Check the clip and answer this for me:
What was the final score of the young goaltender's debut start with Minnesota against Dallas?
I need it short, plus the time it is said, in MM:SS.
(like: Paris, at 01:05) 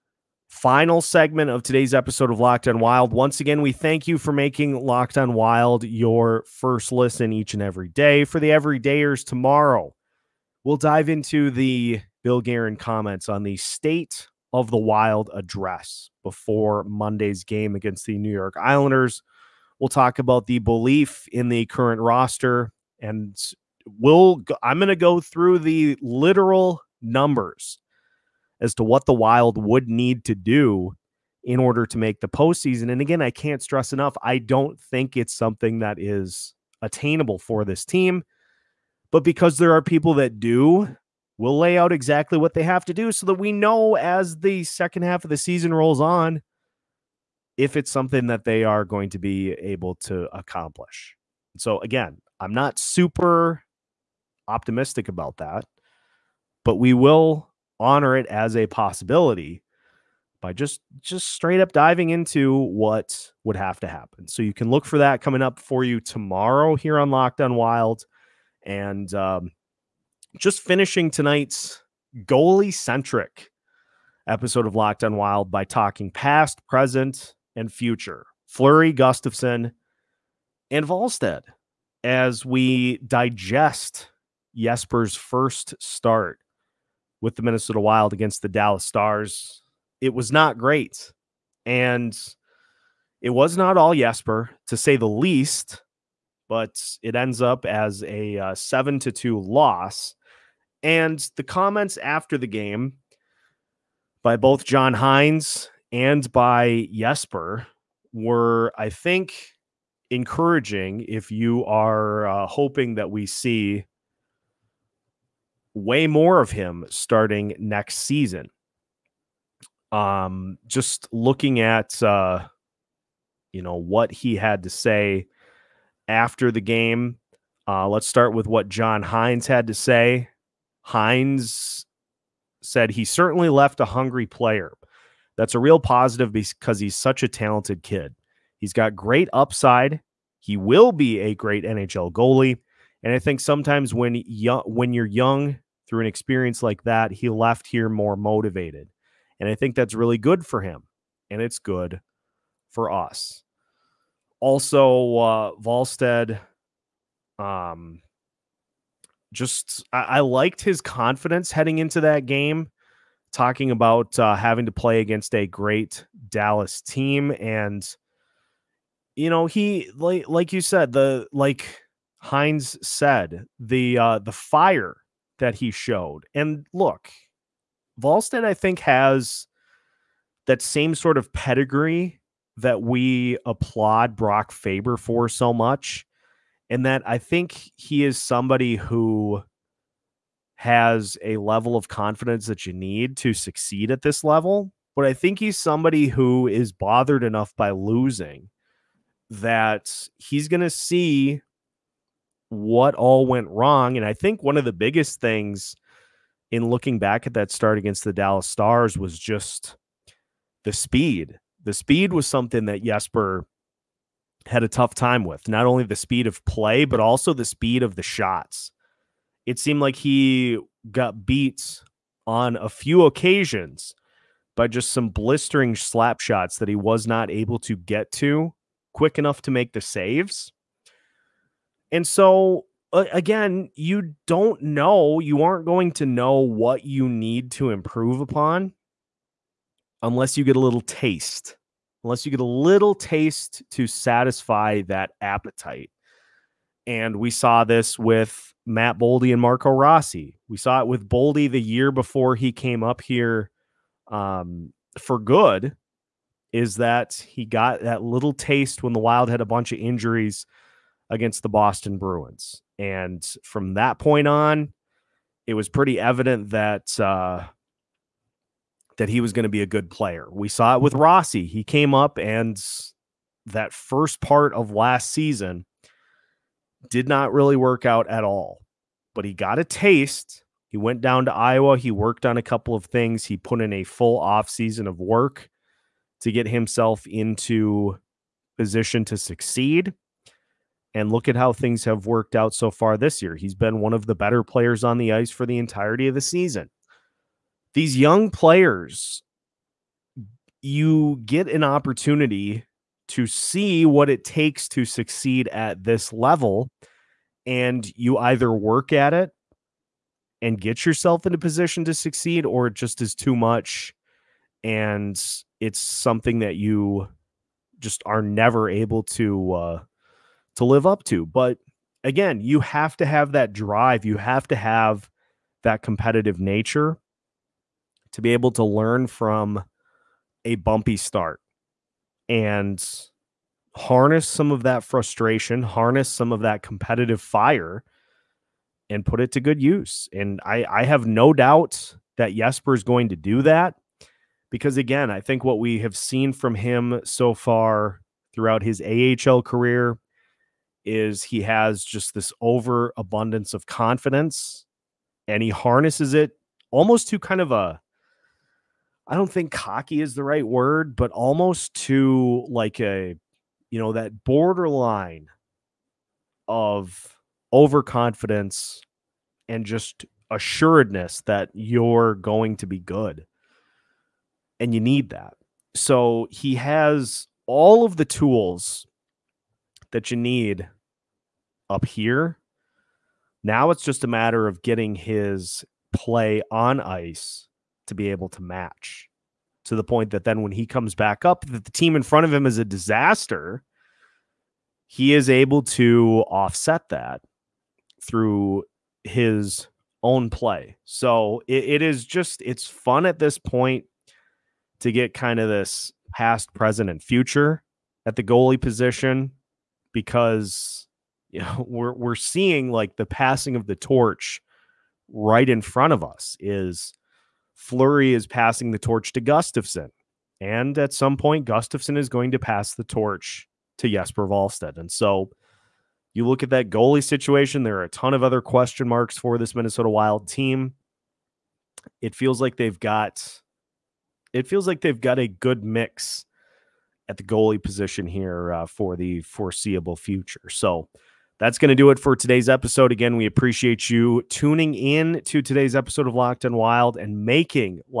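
7-2, at 01:38.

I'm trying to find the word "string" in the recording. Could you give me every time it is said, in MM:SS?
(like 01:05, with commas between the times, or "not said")
not said.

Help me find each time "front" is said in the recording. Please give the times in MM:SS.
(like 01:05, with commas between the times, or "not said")
06:32, 06:55.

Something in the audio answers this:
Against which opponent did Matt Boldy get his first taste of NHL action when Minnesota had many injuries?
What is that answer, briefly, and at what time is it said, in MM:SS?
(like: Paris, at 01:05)
Boston Bruins, at 04:21.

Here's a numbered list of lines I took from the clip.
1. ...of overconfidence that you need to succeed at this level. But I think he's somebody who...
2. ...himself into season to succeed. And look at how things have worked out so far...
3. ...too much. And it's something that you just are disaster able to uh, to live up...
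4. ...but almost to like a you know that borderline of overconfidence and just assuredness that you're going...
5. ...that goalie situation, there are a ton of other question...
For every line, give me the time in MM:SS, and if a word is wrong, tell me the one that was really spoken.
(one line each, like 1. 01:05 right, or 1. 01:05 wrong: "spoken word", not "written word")
1. 03:11 wrong: "confidence", not "overconfidence"
2. 04:46 wrong: "position", not "season"
3. 05:13 wrong: "never", not "disaster"
4. 06:00 right
5. 07:06 right.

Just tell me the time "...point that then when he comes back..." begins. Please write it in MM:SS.
06:29.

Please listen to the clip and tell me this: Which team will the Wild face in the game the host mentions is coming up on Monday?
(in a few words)
New York Islanders.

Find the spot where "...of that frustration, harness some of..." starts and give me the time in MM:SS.
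05:34.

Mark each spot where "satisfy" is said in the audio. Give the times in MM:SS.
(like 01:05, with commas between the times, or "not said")
04:03.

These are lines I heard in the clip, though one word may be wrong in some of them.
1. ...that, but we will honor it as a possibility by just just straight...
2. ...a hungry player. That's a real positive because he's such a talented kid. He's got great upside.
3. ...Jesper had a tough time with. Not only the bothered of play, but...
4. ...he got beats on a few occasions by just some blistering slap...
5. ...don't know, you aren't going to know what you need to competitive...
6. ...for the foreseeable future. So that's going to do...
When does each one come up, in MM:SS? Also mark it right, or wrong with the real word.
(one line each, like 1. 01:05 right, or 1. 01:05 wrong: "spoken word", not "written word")
1. 00:55 right
2. 02:13 right
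3. 03:32 wrong: "speed", not "bothered"
4. 03:39 right
5. 03:54 wrong: "improve", not "competitive"
6. 07:18 right.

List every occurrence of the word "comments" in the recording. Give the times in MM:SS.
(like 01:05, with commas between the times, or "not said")
00:12, 01:41.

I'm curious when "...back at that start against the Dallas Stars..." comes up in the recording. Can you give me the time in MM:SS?
03:26.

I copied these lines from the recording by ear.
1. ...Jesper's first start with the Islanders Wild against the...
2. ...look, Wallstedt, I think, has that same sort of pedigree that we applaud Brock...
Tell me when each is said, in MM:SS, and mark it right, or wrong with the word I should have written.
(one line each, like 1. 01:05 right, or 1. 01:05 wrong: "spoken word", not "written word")
1. 01:24 wrong: "Minnesota", not "Islanders"
2. 02:56 right.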